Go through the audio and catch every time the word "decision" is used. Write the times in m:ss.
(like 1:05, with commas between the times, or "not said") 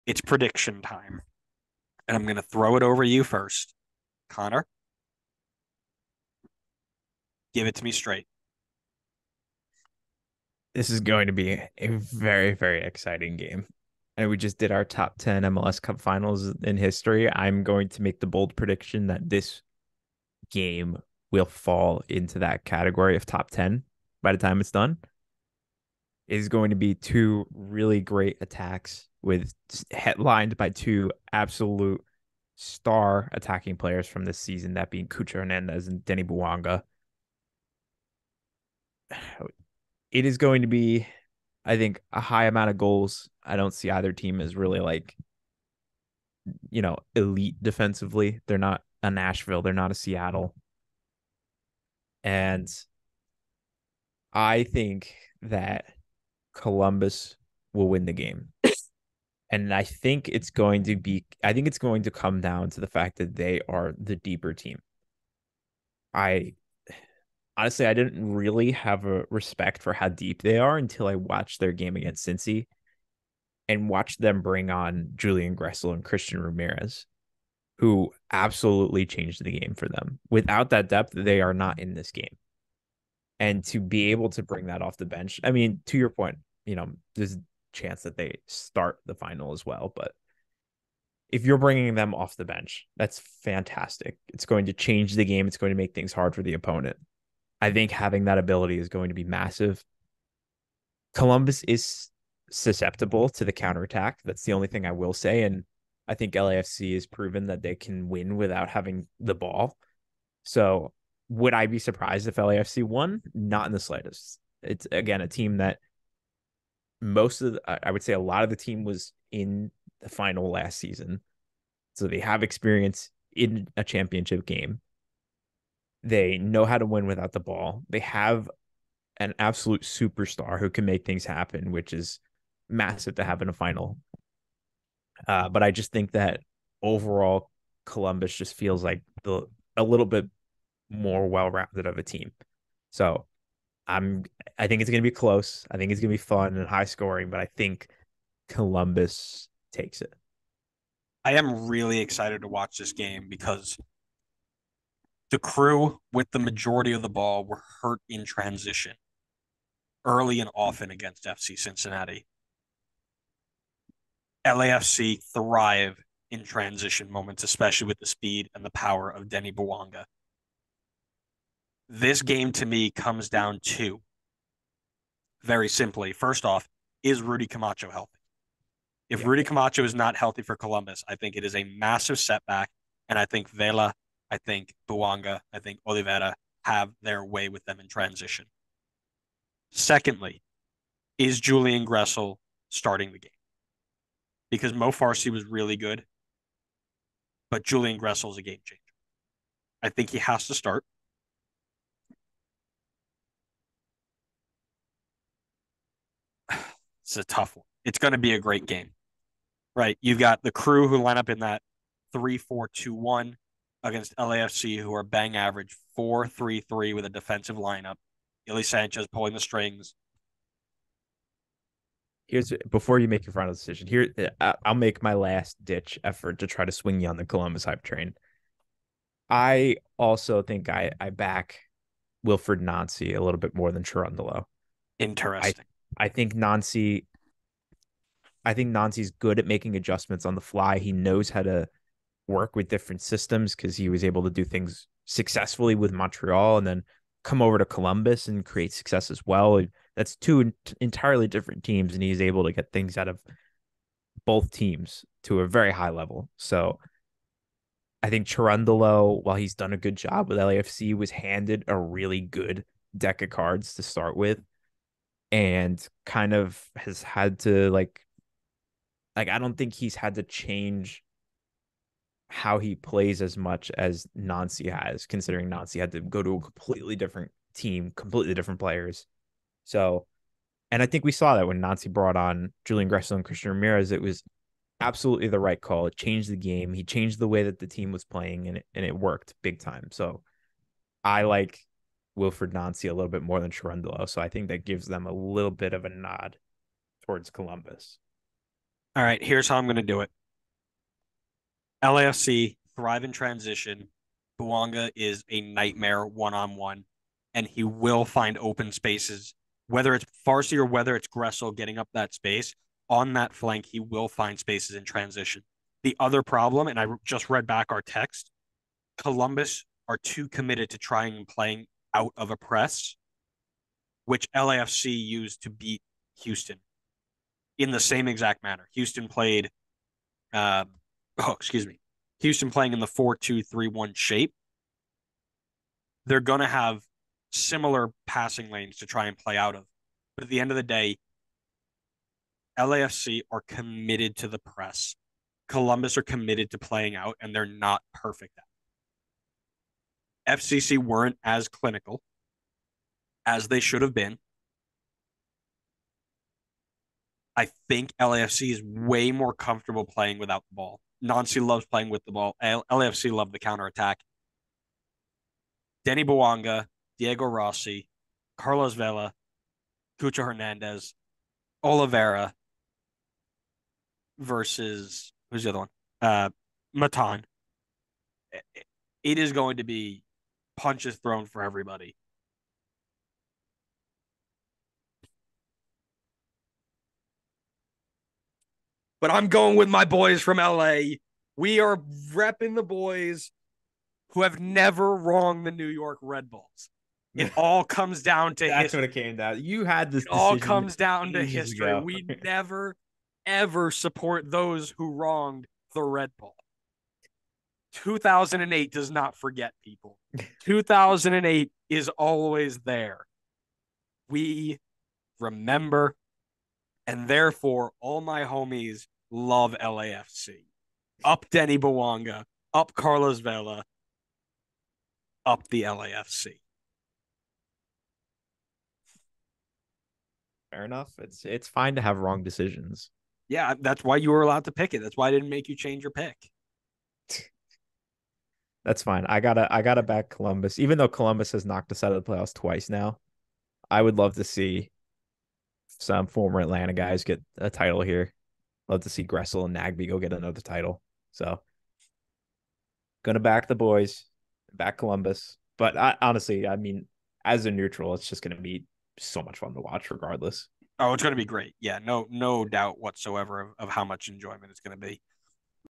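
3:43, 7:12.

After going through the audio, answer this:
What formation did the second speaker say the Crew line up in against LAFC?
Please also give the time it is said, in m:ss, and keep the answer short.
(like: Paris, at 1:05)
3-4-2-1, at 3:32.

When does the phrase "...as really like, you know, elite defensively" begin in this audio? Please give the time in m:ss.
0:44.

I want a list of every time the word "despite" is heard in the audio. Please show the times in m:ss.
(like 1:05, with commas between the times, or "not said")
not said.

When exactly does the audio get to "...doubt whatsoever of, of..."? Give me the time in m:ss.
7:42.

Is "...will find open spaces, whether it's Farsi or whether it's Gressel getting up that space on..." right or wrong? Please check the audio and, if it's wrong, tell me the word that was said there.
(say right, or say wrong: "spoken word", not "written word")
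right.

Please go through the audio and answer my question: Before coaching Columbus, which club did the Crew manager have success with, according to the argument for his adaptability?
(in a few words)
Montreal.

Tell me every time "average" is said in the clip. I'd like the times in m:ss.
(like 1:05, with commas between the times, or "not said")
3:35.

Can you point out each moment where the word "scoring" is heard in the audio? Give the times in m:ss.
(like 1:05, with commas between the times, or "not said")
2:26.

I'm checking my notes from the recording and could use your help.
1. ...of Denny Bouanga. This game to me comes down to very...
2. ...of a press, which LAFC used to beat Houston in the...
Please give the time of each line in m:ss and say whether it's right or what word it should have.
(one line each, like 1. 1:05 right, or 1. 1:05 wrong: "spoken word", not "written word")
1. 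2:49 right
2. 5:22 right.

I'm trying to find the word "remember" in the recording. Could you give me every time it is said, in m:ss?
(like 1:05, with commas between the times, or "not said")
6:55.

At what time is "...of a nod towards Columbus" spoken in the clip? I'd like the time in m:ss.
4:55.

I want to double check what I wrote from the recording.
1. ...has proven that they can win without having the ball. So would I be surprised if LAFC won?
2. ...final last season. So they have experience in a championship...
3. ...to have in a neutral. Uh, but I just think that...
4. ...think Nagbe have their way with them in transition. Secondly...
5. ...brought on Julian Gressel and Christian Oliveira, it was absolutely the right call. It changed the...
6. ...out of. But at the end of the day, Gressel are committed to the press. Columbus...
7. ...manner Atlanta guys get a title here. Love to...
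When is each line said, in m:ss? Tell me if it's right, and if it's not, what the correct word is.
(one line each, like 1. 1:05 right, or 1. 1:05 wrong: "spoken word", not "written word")
1. 1:46 right
2. 2:00 right
3. 2:13 wrong: "final", not "neutral"
4. 3:05 wrong: "Oliveira", not "Nagbe"
5. 4:41 wrong: "Ramirez", not "Oliveira"
6. 5:39 wrong: "LAFC", not "Gressel"
7. 7:26 wrong: "former", not "manner".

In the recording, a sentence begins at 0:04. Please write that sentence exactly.
Connor, give it to me straight.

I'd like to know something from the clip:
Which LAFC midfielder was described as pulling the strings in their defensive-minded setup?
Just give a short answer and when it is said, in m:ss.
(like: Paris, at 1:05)
Ilie Sanchez, at 3:38.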